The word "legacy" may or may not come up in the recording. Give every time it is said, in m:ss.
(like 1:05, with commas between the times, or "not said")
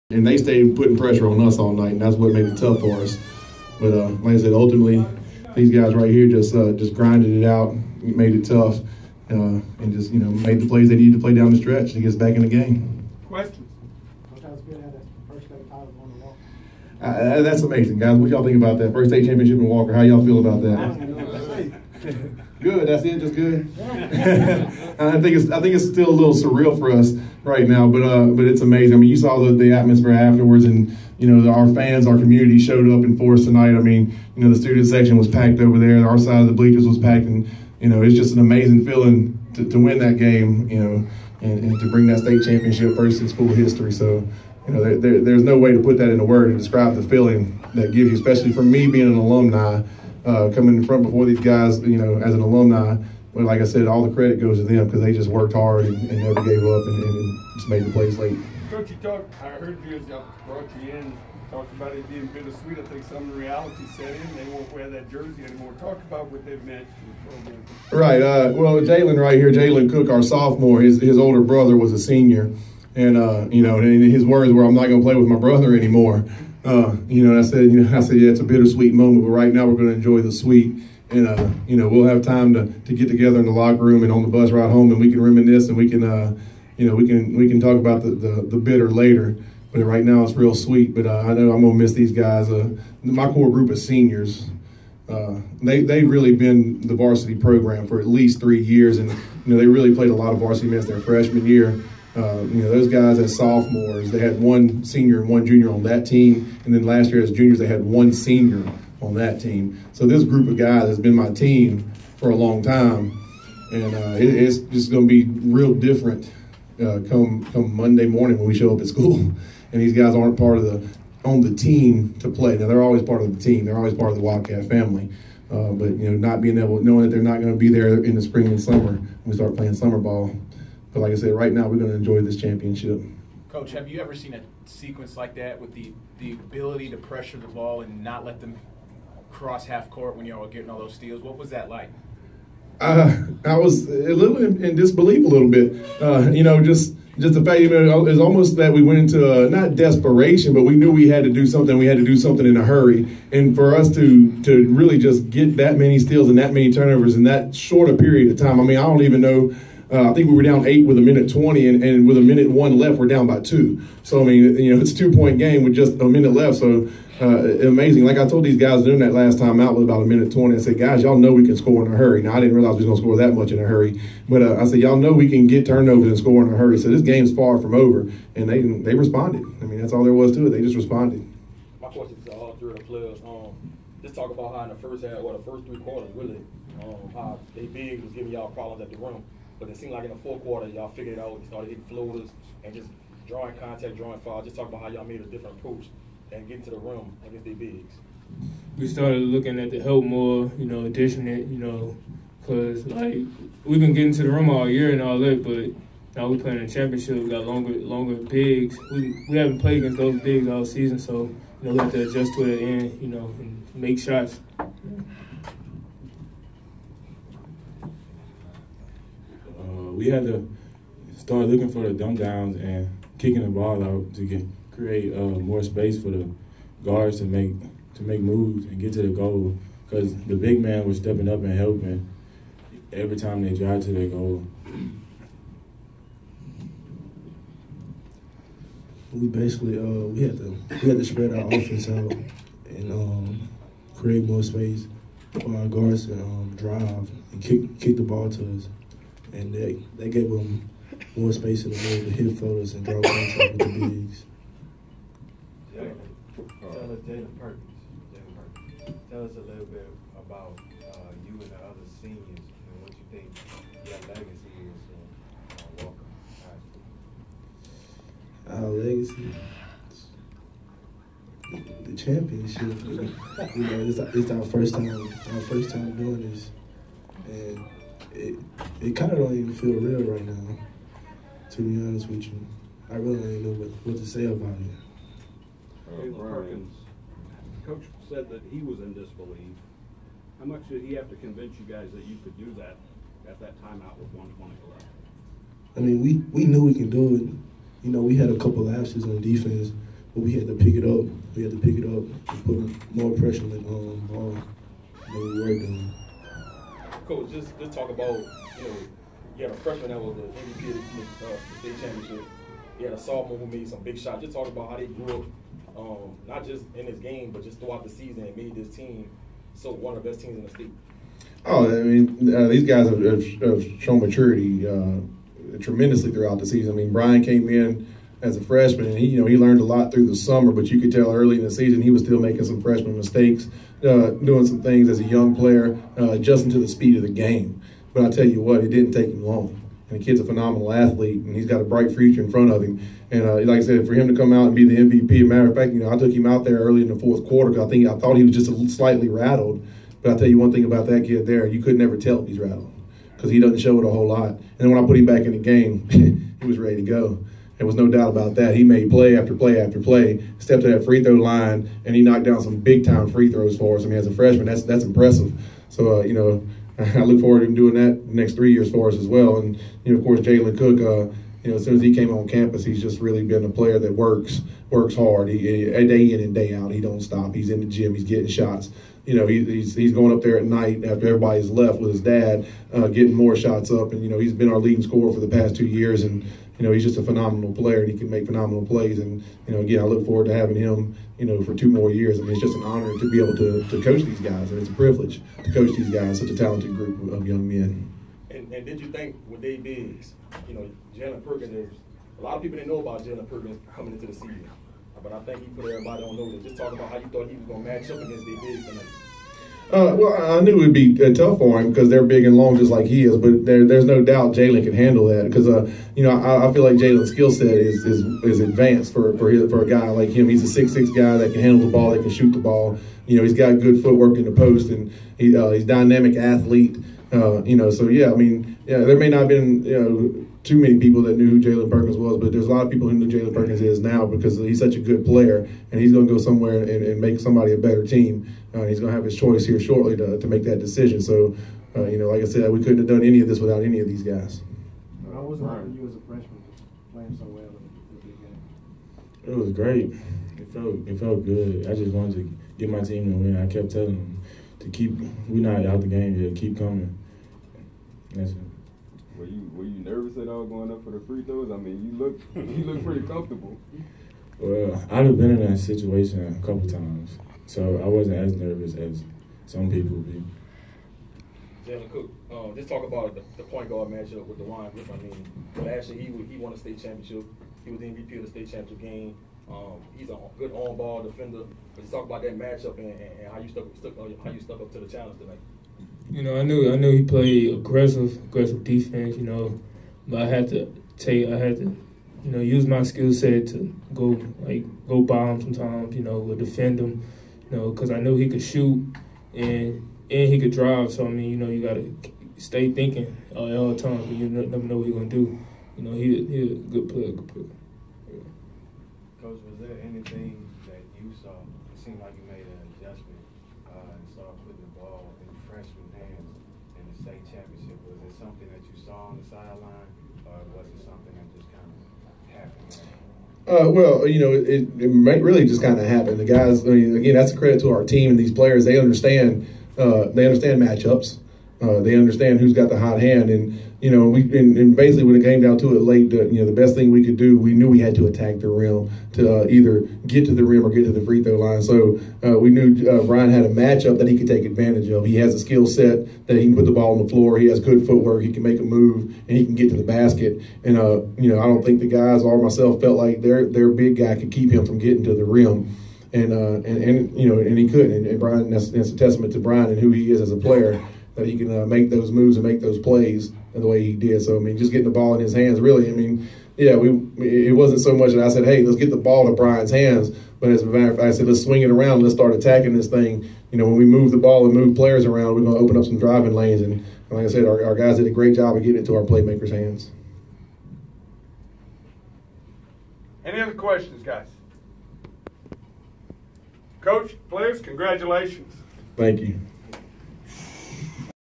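4:24, 4:28.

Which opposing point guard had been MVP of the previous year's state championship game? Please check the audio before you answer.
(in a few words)
DeWine Griffin.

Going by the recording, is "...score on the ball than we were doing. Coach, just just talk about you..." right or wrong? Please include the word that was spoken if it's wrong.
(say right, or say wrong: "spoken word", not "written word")
wrong: "pressure", not "score".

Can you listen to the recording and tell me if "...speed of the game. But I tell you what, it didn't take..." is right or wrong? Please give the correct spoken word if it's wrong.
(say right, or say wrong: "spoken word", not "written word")
right.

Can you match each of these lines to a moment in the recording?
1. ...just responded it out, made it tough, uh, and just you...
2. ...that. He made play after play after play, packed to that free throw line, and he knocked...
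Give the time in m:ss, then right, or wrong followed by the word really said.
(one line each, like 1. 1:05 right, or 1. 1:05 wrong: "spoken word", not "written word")
1. 0:06 wrong: "grinded", not "responded"
2. 5:58 wrong: "stepped", not "packed".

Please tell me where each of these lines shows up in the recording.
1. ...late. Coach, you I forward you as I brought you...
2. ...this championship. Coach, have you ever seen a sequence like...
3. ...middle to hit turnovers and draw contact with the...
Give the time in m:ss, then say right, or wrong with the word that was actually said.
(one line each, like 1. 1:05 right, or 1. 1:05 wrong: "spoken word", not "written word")
1. 0:58 wrong: "heard", not "forward"
2. 2:12 right
3. 4:11 wrong: "floaters", not "turnovers".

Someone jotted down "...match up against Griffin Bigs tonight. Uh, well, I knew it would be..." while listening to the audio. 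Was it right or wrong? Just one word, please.
wrong.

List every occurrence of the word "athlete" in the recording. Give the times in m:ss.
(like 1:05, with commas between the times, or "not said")
5:40, 7:06.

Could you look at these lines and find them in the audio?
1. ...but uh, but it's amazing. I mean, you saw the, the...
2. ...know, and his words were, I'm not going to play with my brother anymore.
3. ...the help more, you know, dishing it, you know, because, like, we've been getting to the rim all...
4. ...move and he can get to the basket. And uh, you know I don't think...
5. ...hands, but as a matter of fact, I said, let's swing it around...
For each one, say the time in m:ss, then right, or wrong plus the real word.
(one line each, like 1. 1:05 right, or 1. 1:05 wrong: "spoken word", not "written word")
1. 0:27 right
2. 1:13 right
3. 3:19 right
4. 9:08 right
5. 9:29 right.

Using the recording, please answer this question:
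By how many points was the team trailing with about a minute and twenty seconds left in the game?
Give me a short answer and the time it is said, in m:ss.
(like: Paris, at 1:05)
8, at 2:40.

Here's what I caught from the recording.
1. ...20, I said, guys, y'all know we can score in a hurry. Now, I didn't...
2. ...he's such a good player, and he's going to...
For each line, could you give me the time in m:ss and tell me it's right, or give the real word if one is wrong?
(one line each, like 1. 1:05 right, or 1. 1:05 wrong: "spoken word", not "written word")
1. 2:50 right
2. 7:14 right.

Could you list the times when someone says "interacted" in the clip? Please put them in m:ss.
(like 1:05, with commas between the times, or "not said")
not said.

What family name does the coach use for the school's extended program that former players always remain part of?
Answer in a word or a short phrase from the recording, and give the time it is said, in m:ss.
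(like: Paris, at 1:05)
Wildcat, at 2:04.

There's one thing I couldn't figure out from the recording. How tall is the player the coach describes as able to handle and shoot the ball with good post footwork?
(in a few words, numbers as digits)
6'6".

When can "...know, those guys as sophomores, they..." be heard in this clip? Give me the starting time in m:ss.
1:42.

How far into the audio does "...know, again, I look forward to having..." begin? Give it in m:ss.
6:29.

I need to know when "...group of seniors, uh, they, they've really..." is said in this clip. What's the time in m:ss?
1:33.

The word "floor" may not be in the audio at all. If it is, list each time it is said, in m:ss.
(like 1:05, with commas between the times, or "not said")
9:07.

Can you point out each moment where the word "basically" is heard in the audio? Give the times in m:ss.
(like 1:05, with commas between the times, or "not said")
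3:59, 8:54.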